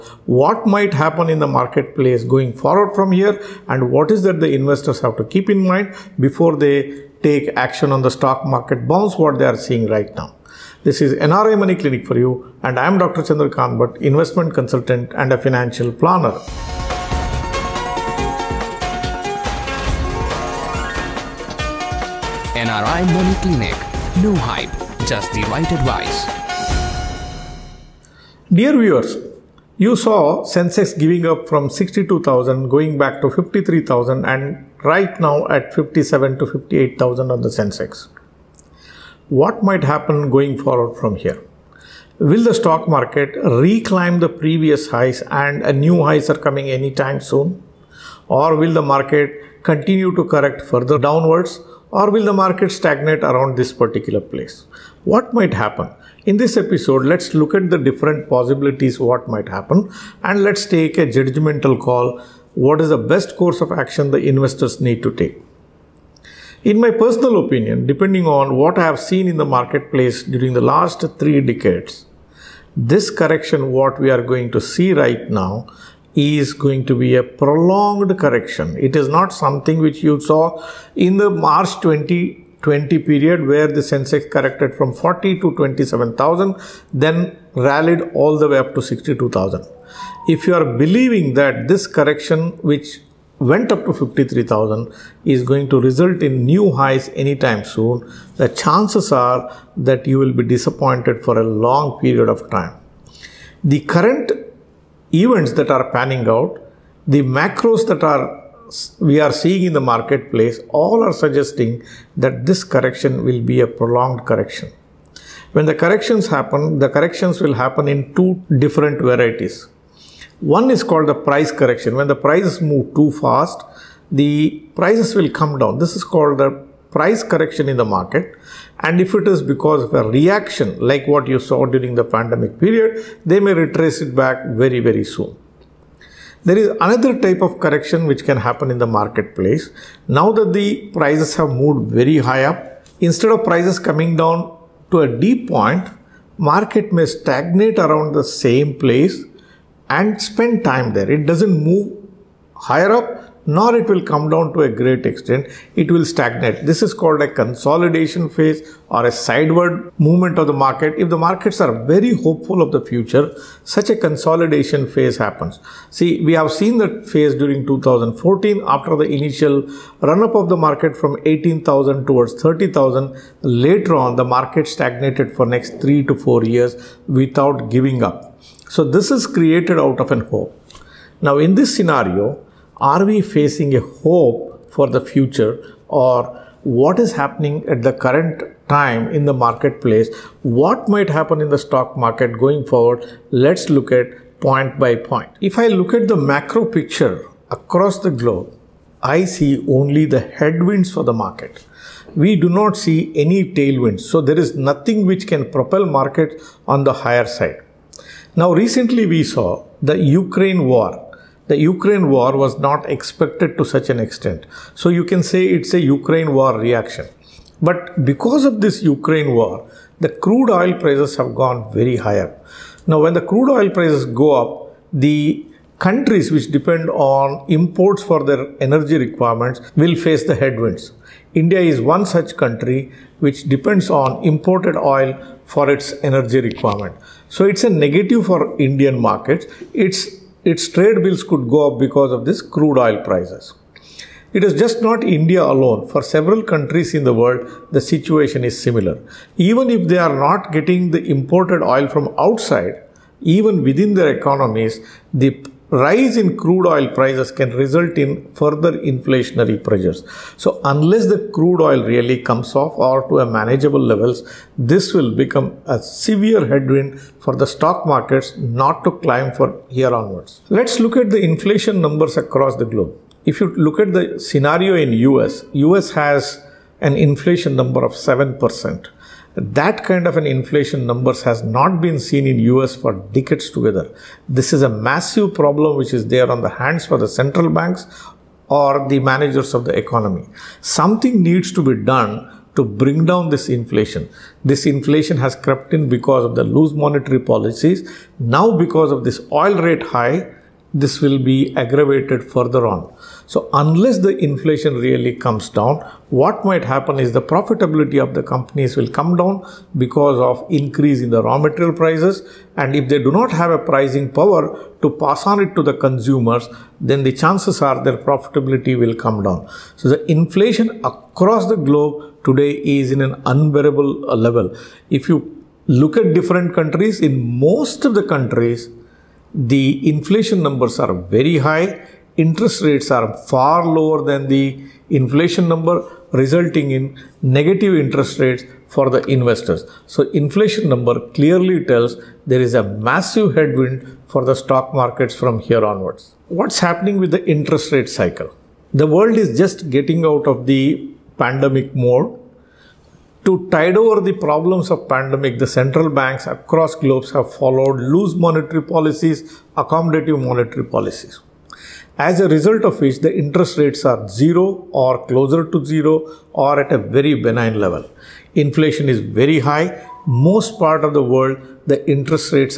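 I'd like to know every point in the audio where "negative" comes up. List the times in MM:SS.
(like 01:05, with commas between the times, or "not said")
03:57, 05:37.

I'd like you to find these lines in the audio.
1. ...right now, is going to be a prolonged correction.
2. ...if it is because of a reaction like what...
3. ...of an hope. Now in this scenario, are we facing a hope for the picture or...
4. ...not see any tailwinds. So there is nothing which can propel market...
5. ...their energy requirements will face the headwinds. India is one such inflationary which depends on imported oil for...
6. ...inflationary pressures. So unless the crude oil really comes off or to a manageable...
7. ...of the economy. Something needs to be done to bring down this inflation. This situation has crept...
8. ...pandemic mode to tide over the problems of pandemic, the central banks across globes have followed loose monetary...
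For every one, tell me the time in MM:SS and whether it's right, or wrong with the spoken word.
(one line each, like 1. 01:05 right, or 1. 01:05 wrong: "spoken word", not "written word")
1. 01:14 right
2. 02:09 right
3. 02:59 wrong: "future", not "picture"
4. 03:22 right
5. 03:48 wrong: "country", not "inflationary"
6. 04:18 right
7. 04:49 wrong: "inflation", not "situation"
8. 05:51 right.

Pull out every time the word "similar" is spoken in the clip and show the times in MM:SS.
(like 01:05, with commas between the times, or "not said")
04:08.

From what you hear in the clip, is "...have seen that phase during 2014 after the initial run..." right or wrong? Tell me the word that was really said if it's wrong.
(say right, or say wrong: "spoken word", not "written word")
right.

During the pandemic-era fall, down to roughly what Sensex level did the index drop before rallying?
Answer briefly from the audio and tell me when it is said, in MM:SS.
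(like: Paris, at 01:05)
27,000, at 01:25.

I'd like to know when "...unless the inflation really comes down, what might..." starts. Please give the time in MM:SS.
05:03.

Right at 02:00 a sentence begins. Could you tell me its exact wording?
One is called the price correction.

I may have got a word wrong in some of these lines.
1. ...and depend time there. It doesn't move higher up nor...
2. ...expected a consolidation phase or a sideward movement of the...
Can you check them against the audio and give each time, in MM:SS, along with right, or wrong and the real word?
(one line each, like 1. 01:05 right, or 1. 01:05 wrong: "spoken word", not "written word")
1. 02:29 wrong: "spend", not "depend"
2. 02:36 wrong: "called", not "expected".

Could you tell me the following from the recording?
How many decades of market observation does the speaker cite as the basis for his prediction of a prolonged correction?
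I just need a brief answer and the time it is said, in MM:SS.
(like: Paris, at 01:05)
3, at 01:11.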